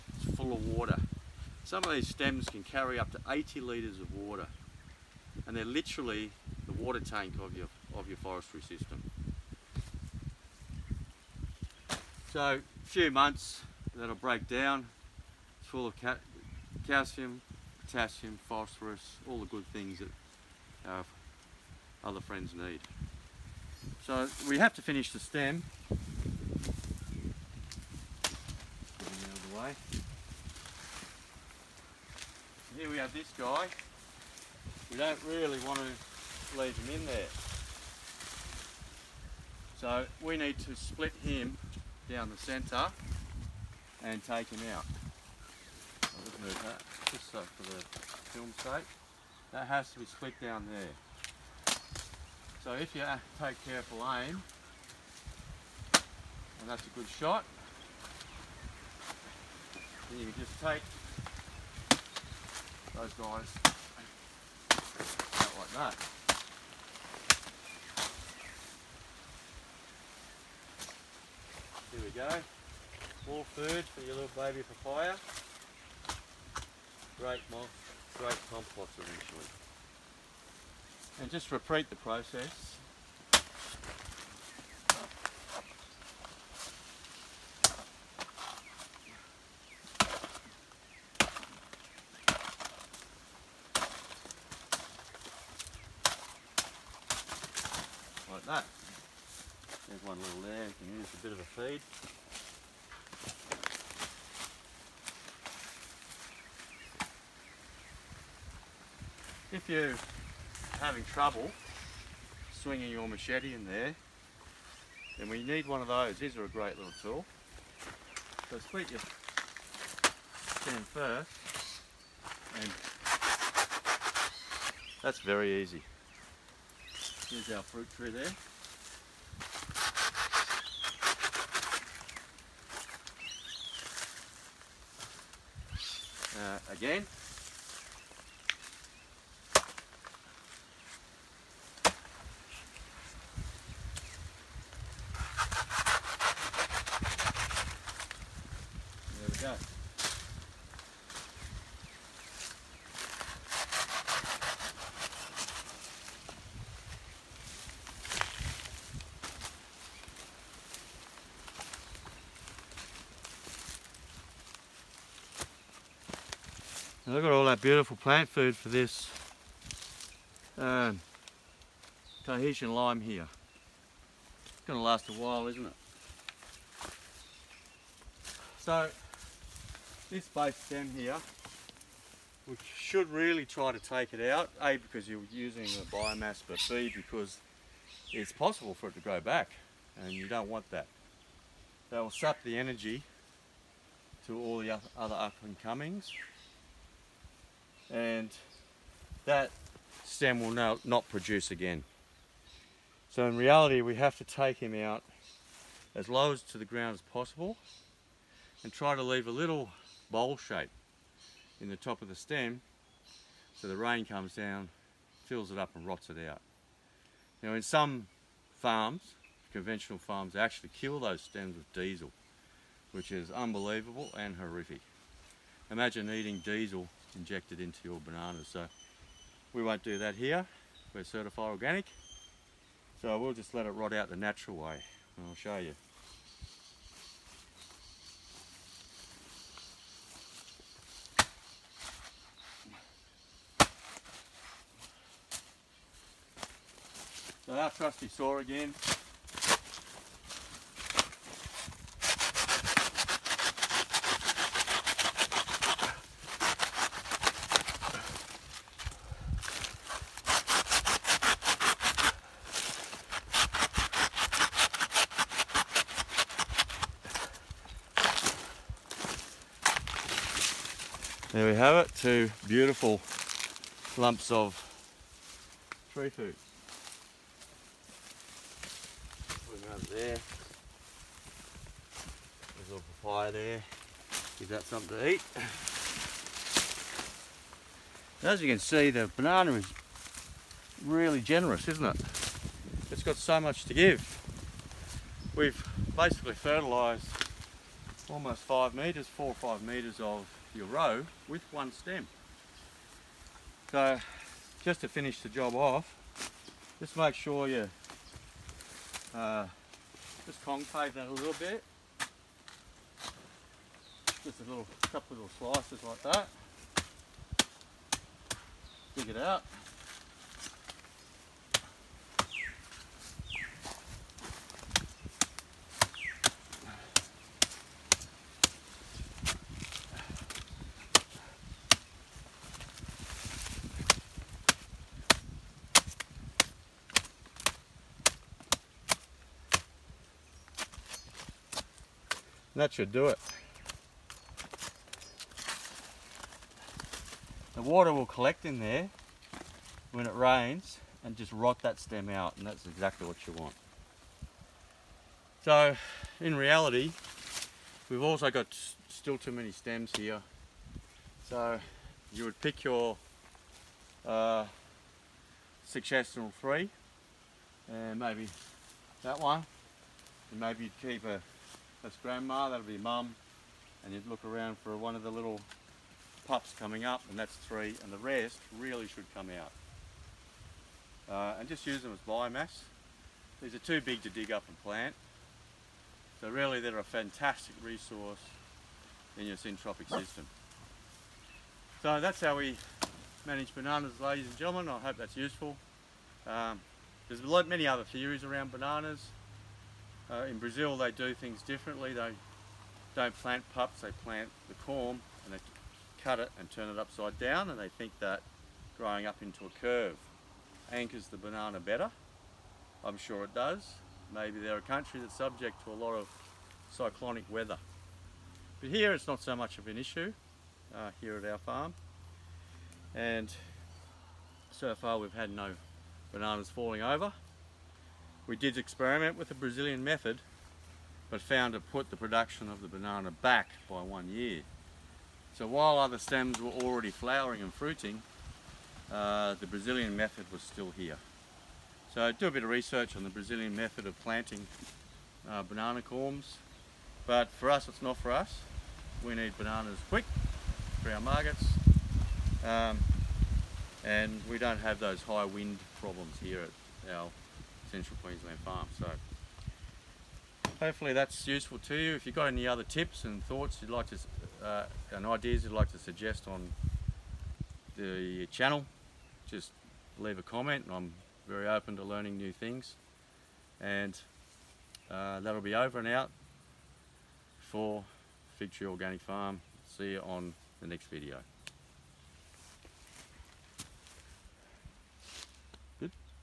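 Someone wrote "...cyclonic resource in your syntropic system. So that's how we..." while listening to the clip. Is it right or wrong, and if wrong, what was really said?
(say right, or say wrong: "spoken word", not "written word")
wrong: "fantastic", not "cyclonic".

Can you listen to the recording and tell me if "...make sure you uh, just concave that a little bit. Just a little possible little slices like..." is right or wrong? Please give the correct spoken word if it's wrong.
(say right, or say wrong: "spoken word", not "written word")
wrong: "couple", not "possible".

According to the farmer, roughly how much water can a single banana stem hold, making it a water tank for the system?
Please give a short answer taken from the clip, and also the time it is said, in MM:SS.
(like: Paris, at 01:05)
80 litres, at 00:03.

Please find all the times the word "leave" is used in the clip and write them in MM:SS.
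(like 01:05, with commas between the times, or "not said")
00:36, 03:29, 07:49.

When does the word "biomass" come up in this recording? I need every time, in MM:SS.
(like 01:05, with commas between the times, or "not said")
03:05, 06:22.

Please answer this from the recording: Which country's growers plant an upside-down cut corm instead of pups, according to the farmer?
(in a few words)
Brazil.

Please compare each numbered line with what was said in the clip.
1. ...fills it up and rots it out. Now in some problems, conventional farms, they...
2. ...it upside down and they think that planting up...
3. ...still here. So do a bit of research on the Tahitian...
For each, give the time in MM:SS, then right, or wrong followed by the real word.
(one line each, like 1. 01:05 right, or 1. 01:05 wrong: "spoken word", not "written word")
1. 03:35 wrong: "farms", not "problems"
2. 06:46 wrong: "growing", not "planting"
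3. 07:20 wrong: "Brazilian", not "Tahitian".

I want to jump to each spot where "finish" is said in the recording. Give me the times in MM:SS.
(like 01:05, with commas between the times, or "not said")
00:24, 05:04.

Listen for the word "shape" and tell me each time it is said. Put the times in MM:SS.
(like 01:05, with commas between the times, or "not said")
03:30.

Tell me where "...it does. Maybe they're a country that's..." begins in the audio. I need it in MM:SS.
06:53.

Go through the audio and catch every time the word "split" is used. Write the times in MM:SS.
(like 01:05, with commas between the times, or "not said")
00:40, 00:50, 01:58.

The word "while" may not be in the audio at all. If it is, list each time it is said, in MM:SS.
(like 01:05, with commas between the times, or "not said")
02:55, 07:15.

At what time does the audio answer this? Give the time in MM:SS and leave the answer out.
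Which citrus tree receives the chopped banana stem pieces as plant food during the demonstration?
02:52.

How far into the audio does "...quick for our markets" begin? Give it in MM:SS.
07:29.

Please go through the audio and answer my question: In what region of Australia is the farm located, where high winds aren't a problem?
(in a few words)
Central Queensland.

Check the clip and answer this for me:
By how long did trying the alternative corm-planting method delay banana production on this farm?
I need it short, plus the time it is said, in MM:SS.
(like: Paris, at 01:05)
1 year, at 07:13.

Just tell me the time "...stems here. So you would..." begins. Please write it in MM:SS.
05:59.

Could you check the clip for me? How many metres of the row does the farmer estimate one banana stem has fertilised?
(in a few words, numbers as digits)
4 or 5 metres.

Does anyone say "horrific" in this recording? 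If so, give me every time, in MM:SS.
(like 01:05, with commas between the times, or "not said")
03:44.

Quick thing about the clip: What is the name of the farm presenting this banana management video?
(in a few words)
Fig Tree Organic Farm.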